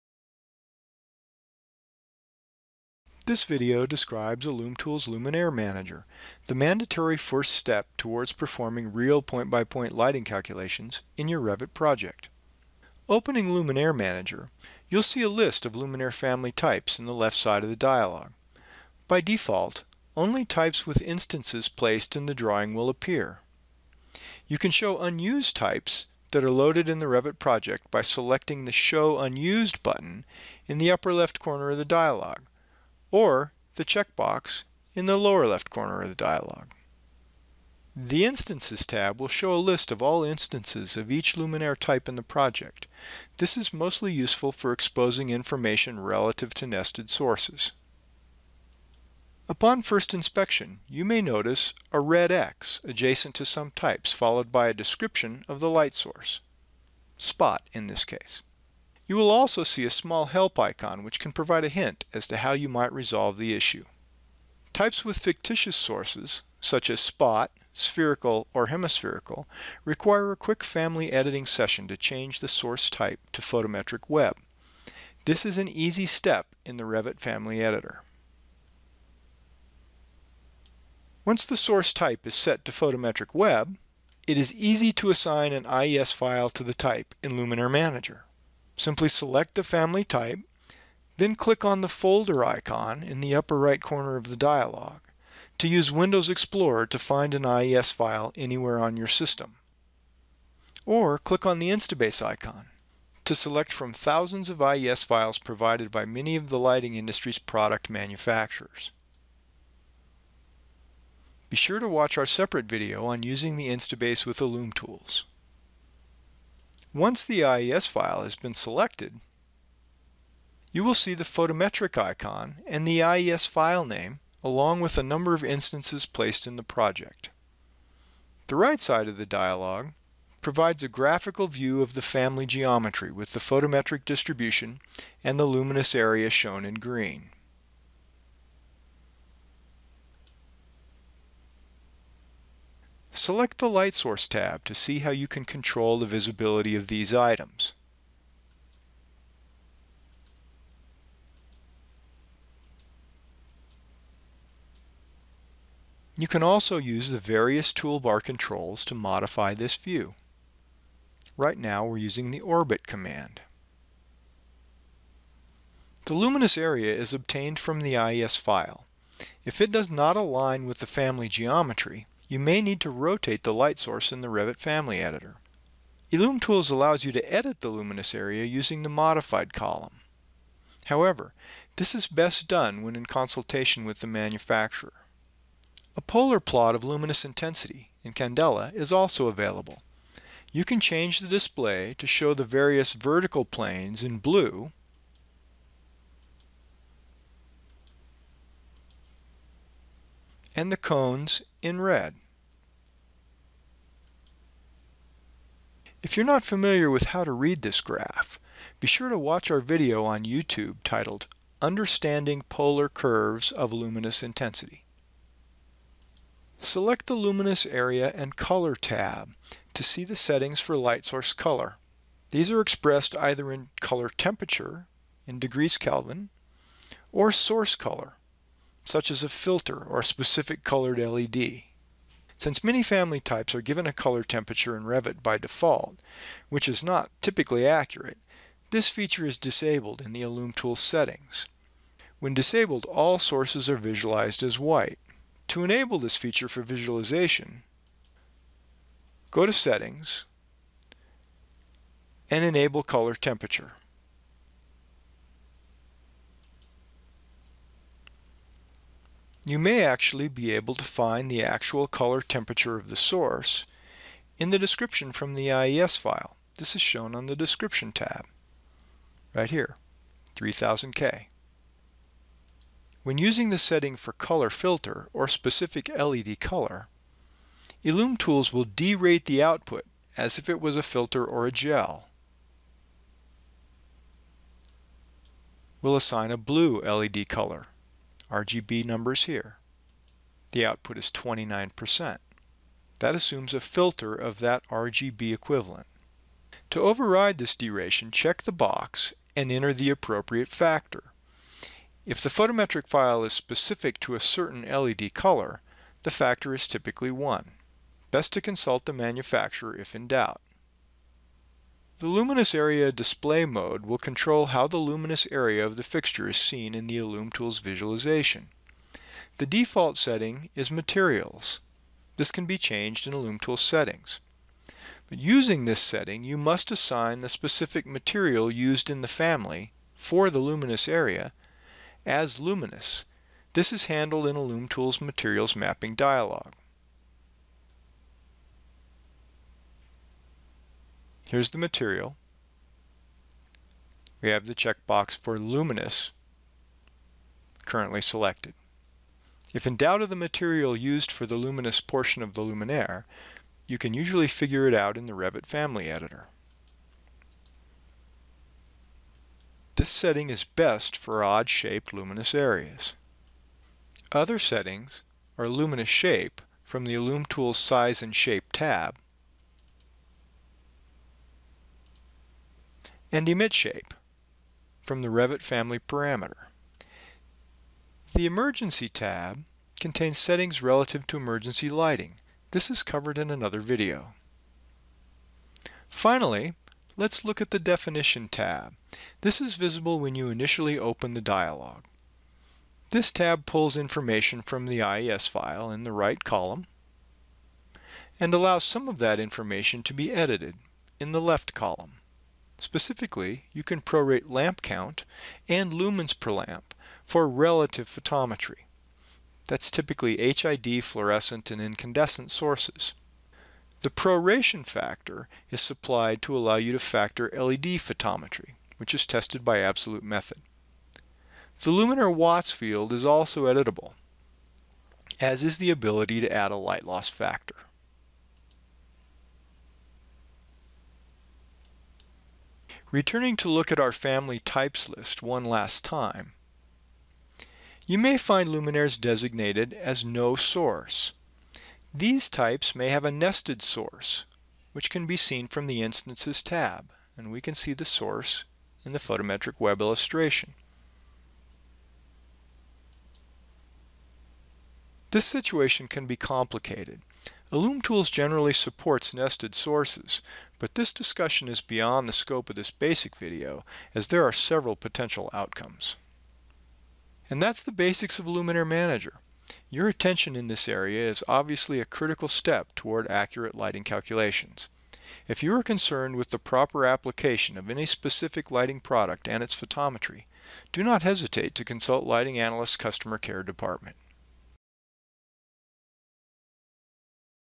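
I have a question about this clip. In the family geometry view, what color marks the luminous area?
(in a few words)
green.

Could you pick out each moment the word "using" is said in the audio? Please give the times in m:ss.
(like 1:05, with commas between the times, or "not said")
1:53, 2:41, 2:58, 4:33, 5:25.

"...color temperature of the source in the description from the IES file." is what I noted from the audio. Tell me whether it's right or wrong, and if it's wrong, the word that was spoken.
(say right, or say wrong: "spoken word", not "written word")
right.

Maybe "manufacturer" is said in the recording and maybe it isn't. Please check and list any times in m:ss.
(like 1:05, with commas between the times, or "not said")
1:47, 3:04, 5:08.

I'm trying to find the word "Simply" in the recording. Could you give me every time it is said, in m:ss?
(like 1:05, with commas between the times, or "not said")
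1:28.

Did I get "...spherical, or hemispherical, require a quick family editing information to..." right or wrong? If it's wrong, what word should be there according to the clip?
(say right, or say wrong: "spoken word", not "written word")
wrong: "session", not "information".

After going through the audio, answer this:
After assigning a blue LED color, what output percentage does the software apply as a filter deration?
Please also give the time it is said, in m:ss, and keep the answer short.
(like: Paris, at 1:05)
29%, at 4:51.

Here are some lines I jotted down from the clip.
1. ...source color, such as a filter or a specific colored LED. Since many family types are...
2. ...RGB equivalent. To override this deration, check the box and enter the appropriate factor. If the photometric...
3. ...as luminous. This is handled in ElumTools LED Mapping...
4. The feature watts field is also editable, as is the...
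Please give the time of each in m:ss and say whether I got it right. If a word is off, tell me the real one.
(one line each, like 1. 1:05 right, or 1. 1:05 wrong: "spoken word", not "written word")
1. 3:47 right
2. 4:54 right
3. 5:32 wrong: "Materials", not "LED"
4. 7:01 wrong: "luminaire", not "feature".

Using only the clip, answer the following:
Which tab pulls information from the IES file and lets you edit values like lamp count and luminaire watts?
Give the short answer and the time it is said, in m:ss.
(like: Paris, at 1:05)
Definition tab, at 6:27.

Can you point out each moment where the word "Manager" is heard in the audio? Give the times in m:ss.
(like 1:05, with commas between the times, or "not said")
0:05, 0:13, 1:27, 7:48.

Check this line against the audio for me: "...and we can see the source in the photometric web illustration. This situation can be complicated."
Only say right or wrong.
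right.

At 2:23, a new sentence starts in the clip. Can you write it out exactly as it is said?
Select the Light Source tab to see how you can control the visibility of these items.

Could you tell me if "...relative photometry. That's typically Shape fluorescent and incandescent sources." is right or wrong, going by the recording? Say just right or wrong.
wrong.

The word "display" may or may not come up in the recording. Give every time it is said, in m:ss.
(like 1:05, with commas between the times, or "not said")
3:11, 5:12.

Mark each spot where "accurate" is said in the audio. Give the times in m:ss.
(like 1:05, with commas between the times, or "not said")
3:57, 7:53.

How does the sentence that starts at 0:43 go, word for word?
This is mostly useful for exposing information relative to nested sources.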